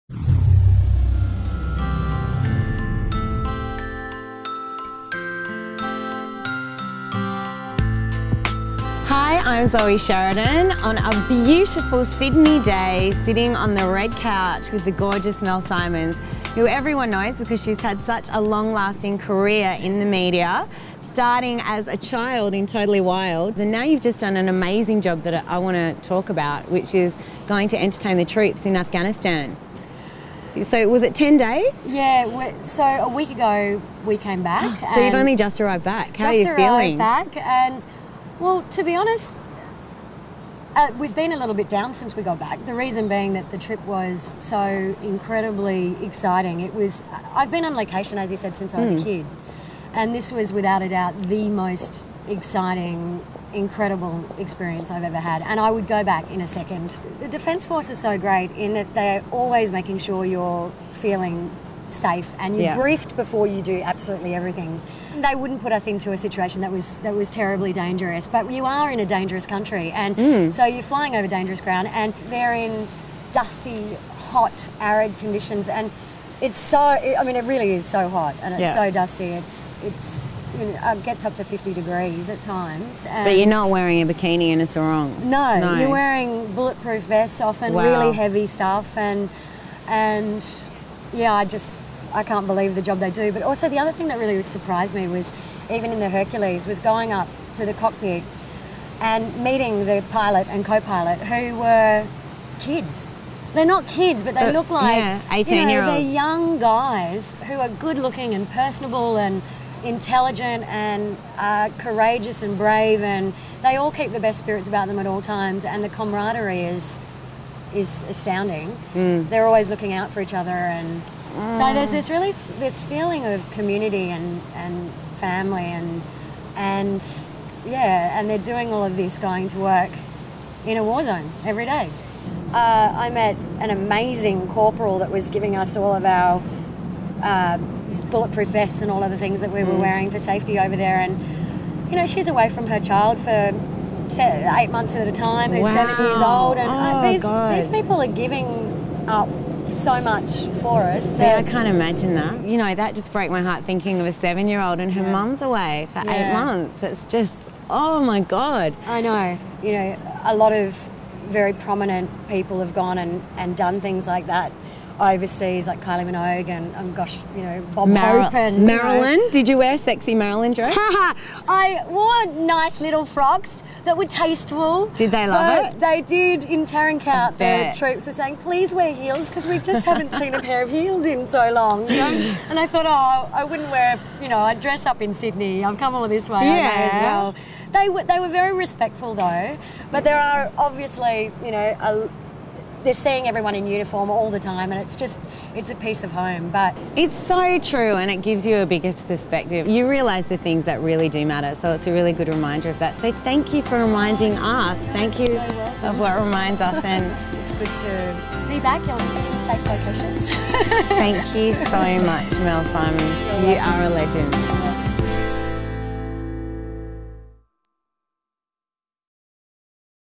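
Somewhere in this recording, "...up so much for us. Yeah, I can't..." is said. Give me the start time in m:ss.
2:29.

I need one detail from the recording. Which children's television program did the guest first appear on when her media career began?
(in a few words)
Totally Wild.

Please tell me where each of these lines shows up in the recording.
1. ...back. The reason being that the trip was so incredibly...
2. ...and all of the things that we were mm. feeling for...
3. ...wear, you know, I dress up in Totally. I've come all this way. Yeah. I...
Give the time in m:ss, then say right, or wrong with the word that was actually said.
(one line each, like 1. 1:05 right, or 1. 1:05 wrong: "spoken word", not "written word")
1. 0:42 right
2. 2:18 wrong: "wearing", not "feeling"
3. 3:03 wrong: "Sydney", not "Totally".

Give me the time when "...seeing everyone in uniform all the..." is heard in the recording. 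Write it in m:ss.
3:12.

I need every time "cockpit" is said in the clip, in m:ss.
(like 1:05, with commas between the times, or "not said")
1:37.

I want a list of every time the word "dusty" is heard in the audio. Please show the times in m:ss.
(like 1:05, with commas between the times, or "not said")
1:13, 1:18.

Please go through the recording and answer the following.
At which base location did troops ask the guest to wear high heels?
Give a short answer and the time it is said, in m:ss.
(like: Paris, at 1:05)
Tarin Kowt, at 2:56.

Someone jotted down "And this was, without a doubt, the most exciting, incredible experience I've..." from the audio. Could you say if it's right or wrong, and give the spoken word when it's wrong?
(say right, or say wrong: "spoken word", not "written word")
right.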